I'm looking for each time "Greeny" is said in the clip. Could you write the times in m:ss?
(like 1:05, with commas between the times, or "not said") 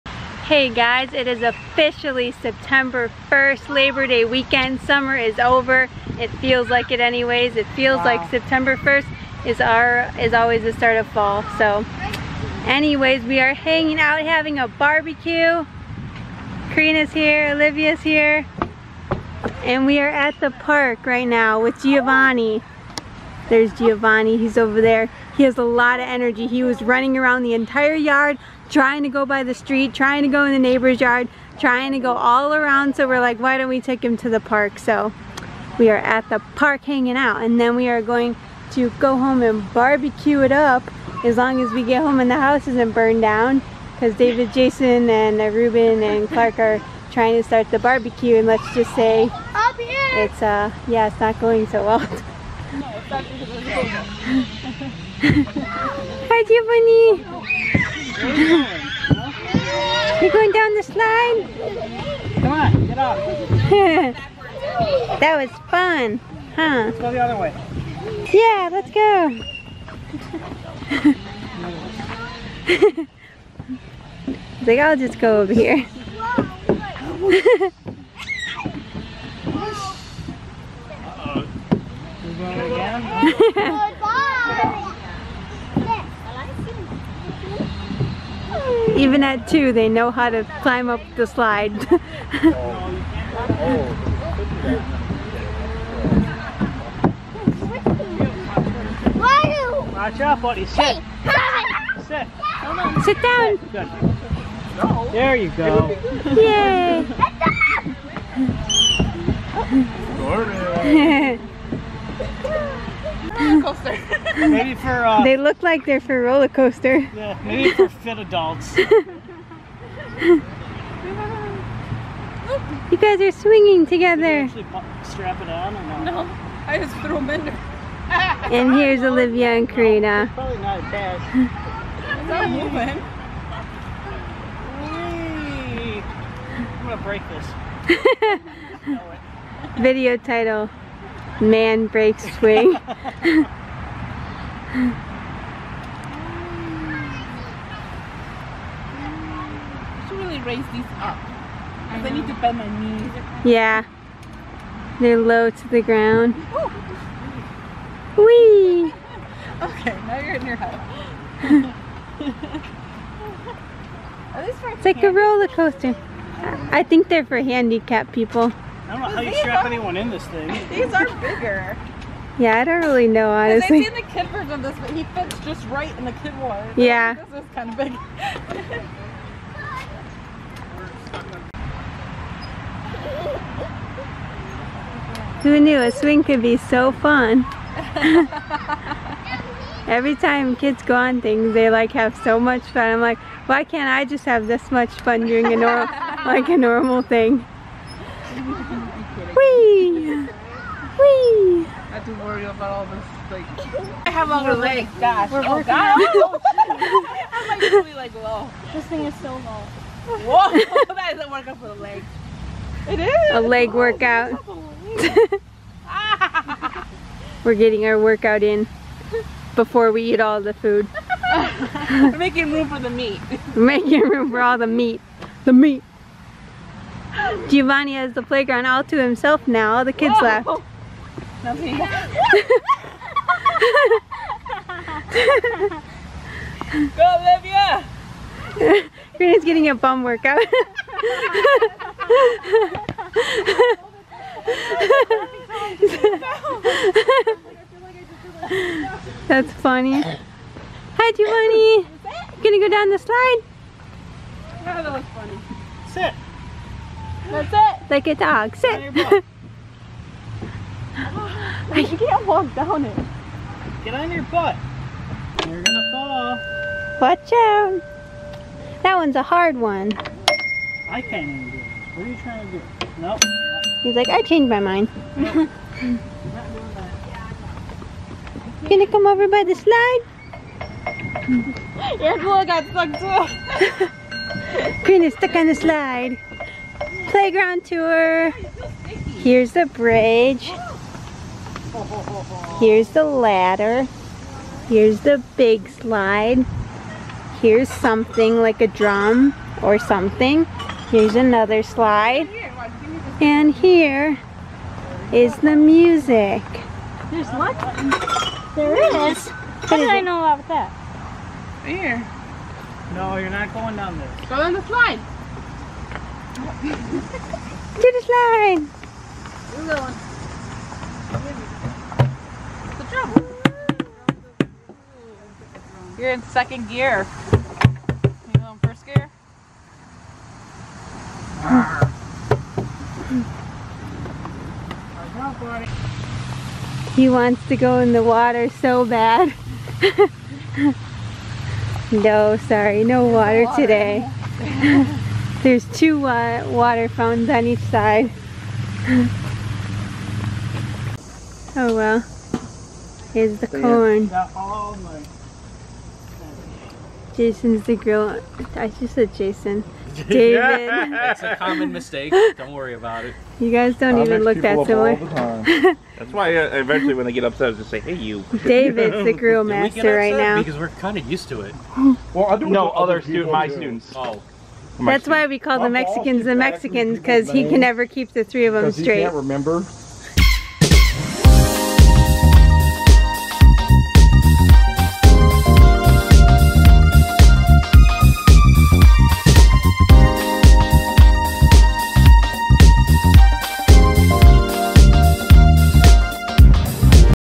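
3:59.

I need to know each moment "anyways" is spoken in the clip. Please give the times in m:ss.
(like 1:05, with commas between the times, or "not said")
0:06, 0:12.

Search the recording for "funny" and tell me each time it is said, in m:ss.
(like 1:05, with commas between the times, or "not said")
4:09, 4:15.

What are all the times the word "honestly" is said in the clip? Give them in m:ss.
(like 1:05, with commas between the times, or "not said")
2:53.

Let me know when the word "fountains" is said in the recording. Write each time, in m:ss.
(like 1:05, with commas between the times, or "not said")
5:46.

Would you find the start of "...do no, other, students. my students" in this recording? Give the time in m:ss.
6:12.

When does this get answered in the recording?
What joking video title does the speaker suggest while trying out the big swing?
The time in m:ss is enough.
2:21.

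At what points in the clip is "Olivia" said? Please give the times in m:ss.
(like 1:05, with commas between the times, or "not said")
0:17, 2:09, 3:58.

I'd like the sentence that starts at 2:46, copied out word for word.
I think they're for handicapped people.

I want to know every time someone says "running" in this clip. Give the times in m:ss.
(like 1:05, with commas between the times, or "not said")
0:26.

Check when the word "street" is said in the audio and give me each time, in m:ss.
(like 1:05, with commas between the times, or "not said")
0:29.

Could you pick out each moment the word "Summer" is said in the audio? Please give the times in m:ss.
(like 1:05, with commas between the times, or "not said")
0:04.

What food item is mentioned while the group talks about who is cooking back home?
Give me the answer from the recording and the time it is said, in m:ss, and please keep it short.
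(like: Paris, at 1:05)
Corn, at 5:53.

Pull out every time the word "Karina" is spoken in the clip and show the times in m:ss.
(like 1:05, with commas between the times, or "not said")
0:16, 2:09.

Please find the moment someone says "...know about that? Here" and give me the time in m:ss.
5:10.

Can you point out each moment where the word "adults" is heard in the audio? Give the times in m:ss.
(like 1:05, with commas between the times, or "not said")
1:58.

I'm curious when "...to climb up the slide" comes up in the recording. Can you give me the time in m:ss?
1:30.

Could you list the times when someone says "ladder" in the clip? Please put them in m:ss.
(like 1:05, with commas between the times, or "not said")
4:53.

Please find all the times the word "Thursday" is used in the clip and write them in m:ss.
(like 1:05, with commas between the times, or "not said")
not said.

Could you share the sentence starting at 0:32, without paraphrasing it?
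So we're like, why don't we take him to the park?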